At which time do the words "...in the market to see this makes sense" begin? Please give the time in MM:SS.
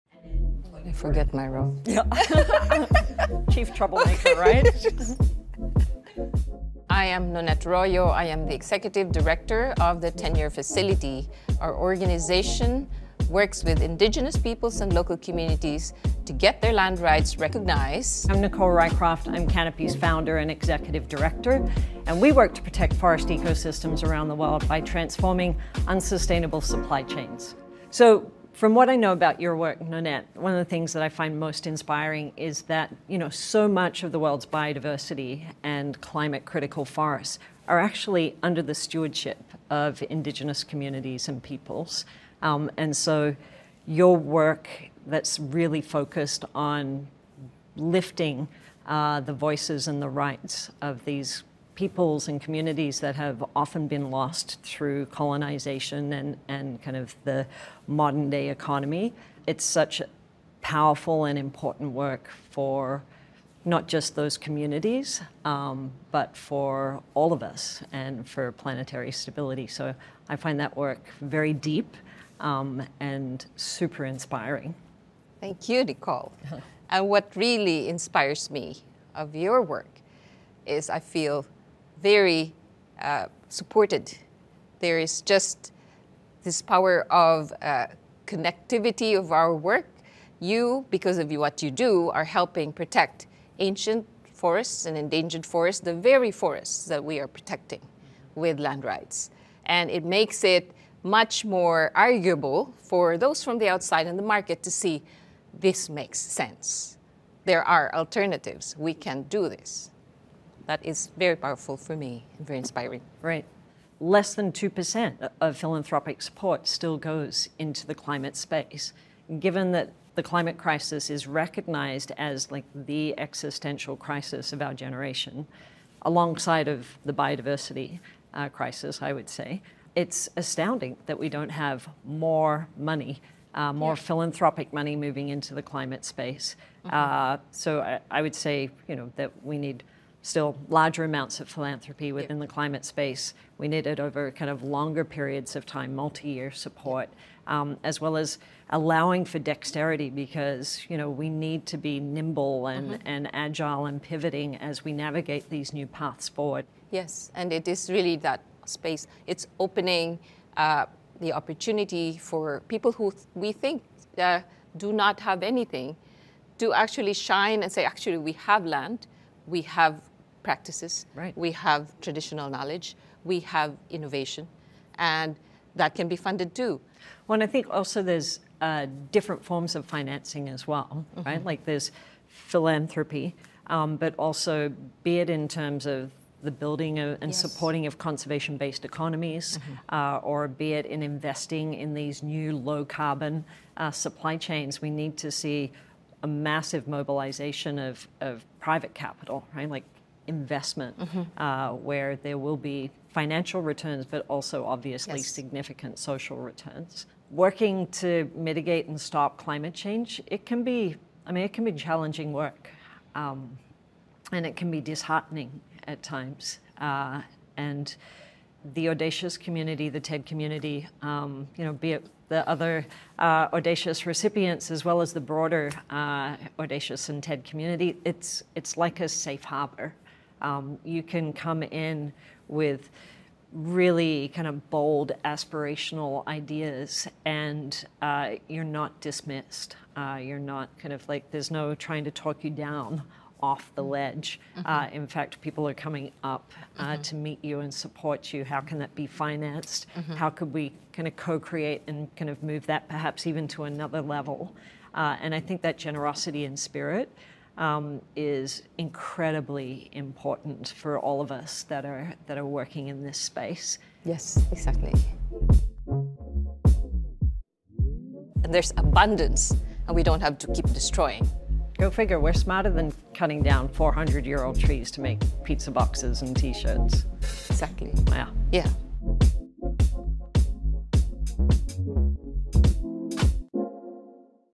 01:44.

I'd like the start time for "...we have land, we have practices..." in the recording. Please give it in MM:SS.
02:48.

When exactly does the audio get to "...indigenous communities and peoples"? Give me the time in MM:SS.
00:40.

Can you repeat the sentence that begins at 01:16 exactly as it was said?
and what really inspires me of your work is I feel very uh, supported.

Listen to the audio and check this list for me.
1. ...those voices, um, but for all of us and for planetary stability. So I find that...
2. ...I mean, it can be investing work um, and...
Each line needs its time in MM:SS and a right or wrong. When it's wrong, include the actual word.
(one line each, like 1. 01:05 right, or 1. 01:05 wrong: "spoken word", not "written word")
1. 01:04 wrong: "communities", not "voices"
2. 03:31 wrong: "challenging", not "investing".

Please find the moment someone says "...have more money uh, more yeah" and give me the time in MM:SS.
02:11.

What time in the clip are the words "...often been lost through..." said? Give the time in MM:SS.
00:53.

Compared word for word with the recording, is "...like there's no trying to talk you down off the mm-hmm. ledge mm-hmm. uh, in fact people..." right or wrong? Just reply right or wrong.
right.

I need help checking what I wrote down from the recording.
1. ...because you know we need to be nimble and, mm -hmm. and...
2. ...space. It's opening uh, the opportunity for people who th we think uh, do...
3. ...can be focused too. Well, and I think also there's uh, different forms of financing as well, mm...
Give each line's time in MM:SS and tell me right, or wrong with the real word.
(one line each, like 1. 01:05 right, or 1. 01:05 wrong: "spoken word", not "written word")
1. 02:30 right
2. 02:38 right
3. 02:55 wrong: "funded", not "focused".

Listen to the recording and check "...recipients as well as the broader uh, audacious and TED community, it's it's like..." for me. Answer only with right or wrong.
right.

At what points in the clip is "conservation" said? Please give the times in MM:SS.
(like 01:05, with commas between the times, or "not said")
03:07.